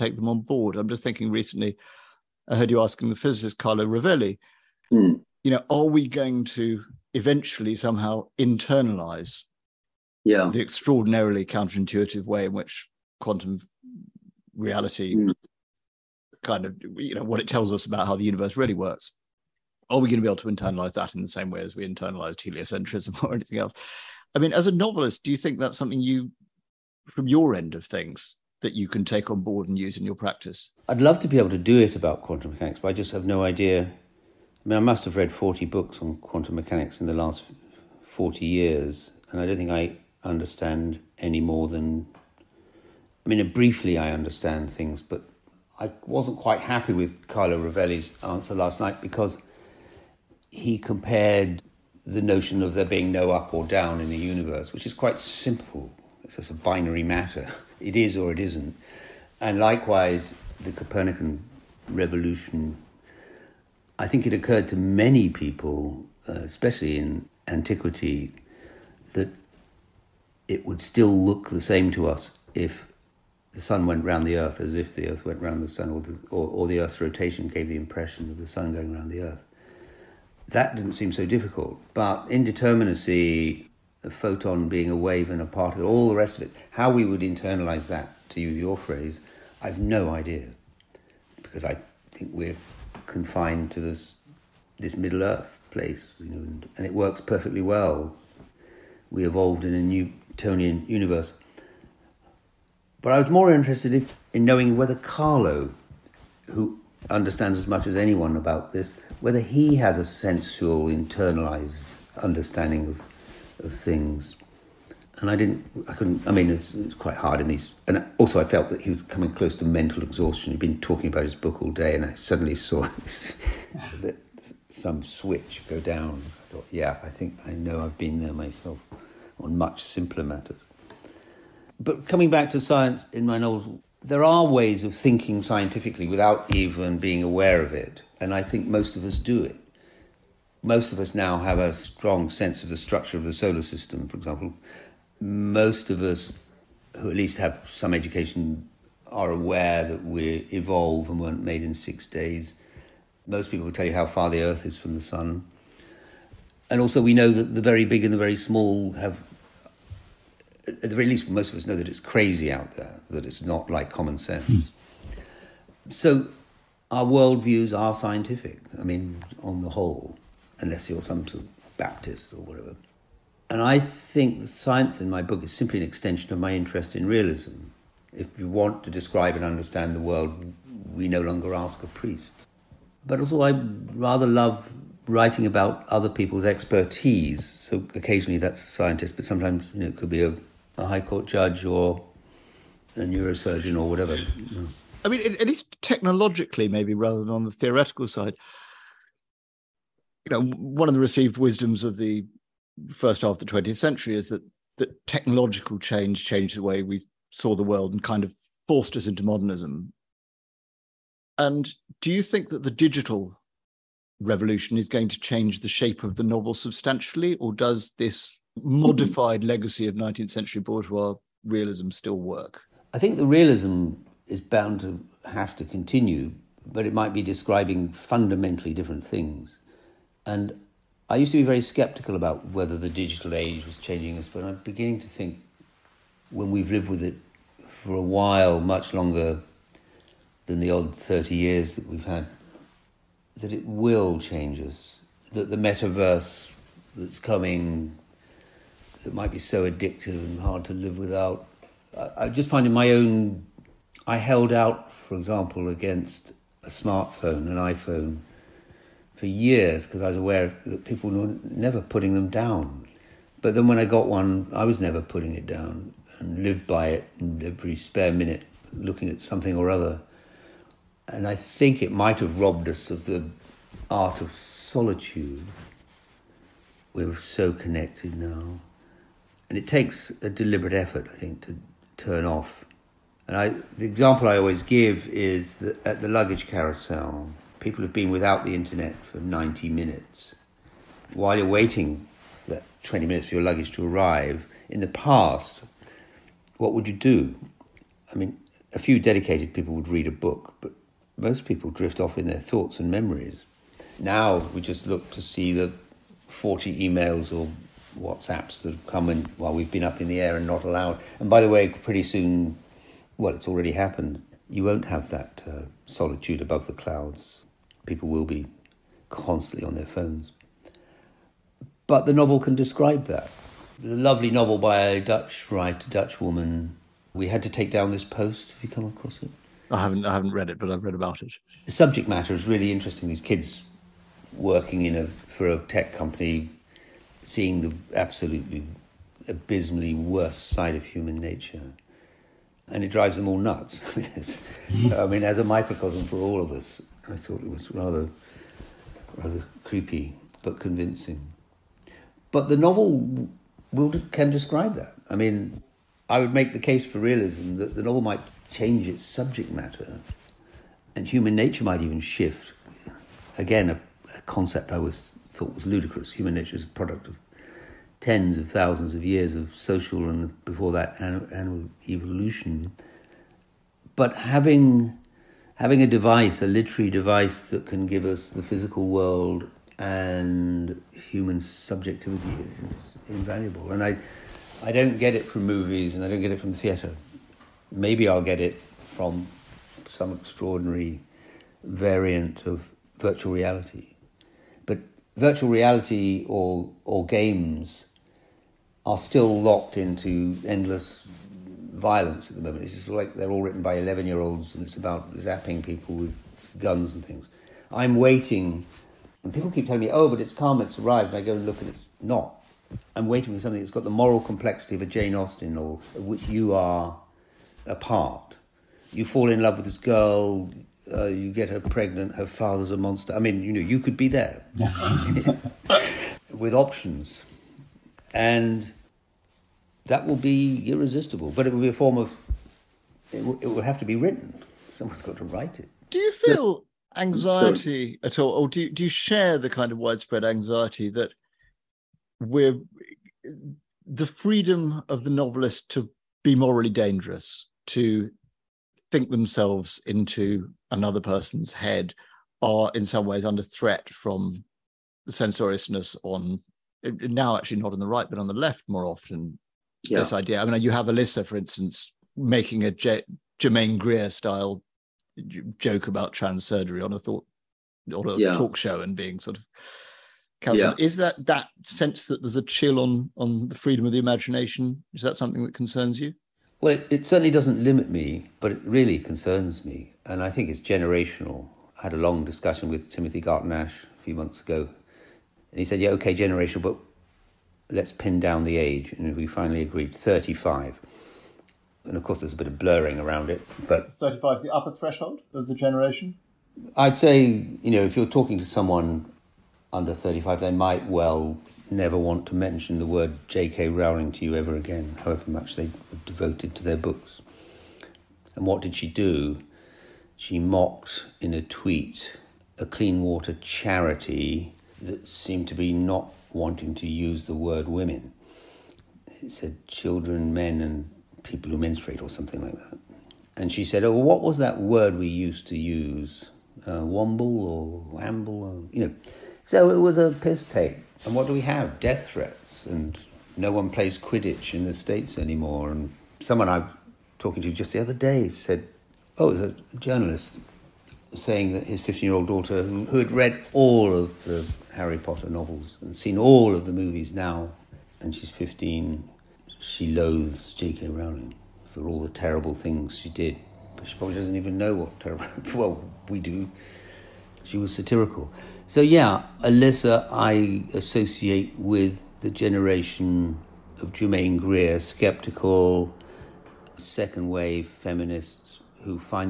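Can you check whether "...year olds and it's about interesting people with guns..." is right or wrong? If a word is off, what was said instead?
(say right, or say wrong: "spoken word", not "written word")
wrong: "zapping", not "interesting".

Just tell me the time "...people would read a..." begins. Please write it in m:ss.
4:59.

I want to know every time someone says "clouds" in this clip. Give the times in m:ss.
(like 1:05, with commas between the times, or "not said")
5:16.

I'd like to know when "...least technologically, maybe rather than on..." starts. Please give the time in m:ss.
3:15.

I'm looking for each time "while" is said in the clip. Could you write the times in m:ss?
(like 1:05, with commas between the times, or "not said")
3:58, 4:51, 5:09.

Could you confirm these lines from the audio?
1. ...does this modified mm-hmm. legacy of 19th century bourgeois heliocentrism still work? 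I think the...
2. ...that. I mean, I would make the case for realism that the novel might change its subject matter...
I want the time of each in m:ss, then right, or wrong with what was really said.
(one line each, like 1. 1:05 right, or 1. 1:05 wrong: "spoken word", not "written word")
1. 3:37 wrong: "realism", not "heliocentrism"
2. 5:54 right.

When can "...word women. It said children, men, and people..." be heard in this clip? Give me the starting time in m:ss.
8:37.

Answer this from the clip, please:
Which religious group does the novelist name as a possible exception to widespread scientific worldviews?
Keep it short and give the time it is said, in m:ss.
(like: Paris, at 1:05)
Baptist, at 2:51.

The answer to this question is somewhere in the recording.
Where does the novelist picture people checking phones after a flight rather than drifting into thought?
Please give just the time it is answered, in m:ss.
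4:46.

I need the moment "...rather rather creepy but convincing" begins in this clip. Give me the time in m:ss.
5:47.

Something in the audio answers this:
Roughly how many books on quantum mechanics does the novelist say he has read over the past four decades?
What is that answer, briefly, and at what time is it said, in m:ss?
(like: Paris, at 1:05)
40, at 0:35.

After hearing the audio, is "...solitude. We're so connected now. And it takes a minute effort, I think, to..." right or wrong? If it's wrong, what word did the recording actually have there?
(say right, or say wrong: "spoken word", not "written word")
wrong: "deliberate", not "minute".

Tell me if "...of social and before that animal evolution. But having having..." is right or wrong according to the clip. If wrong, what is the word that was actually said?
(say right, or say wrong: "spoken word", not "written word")
right.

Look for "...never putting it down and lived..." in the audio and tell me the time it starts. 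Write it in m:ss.
4:24.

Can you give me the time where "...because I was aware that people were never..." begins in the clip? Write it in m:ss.
4:19.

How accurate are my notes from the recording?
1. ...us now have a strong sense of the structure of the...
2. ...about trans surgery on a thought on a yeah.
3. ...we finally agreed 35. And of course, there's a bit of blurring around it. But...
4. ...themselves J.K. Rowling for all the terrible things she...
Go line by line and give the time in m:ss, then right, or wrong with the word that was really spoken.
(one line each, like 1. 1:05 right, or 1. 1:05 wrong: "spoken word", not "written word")
1. 2:20 right
2. 7:45 right
3. 8:09 right
4. 9:09 wrong: "loathes", not "themselves".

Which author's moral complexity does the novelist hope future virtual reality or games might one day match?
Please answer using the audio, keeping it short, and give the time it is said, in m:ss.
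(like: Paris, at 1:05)
Jane Austen, at 6:54.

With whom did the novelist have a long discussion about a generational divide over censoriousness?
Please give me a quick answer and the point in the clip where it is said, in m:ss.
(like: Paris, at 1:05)
Timothy Garton Ash, at 8:02.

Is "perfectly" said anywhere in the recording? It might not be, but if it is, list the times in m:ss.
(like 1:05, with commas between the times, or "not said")
1:37.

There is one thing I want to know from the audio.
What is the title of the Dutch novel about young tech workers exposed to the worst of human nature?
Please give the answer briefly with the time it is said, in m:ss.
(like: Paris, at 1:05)
We Had to Take Down This Post, at 5:27.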